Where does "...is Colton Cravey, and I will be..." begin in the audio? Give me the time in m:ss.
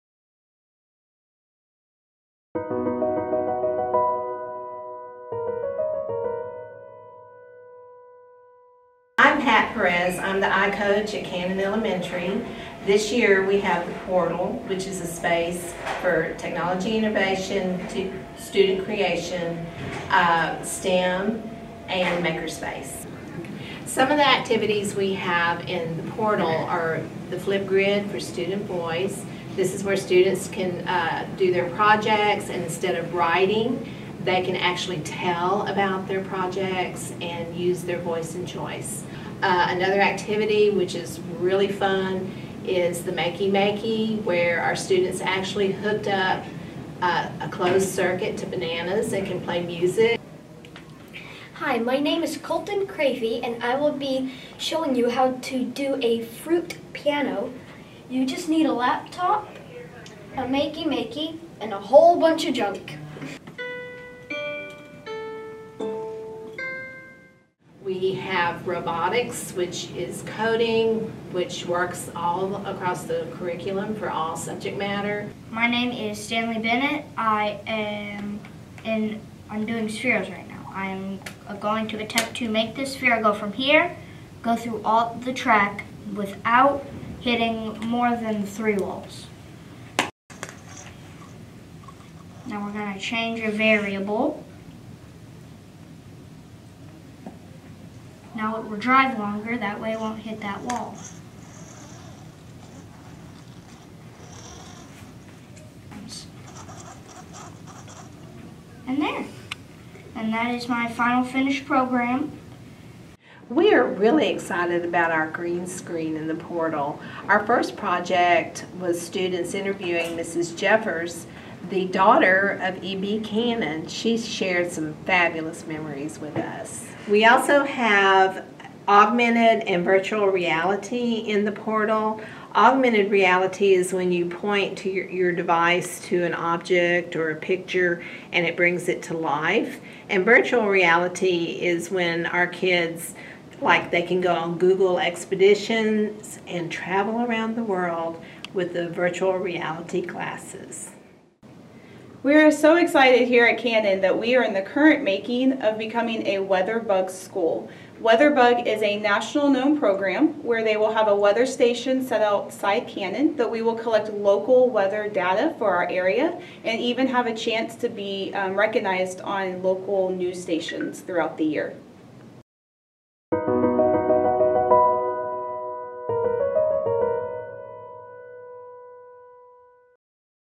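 0:52.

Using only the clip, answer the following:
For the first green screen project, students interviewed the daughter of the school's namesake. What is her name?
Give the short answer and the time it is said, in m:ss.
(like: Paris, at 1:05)
Mrs. Jeffers, at 2:00.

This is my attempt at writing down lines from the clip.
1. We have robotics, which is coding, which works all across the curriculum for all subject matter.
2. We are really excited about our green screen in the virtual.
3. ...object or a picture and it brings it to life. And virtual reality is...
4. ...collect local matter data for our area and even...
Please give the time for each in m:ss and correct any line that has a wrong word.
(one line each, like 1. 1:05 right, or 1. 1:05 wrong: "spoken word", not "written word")
1. 1:07 right
2. 1:53 wrong: "portal", not "virtual"
3. 2:16 right
4. 2:43 wrong: "weather", not "matter".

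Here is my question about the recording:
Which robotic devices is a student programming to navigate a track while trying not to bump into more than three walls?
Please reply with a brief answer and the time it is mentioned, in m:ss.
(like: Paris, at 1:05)
Spheros, at 1:19.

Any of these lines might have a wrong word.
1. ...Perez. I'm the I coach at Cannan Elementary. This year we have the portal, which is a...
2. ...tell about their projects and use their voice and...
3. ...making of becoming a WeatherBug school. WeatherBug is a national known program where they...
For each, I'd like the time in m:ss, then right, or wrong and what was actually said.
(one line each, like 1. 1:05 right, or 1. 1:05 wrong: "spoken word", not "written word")
1. 0:09 right
2. 0:34 right
3. 2:35 right.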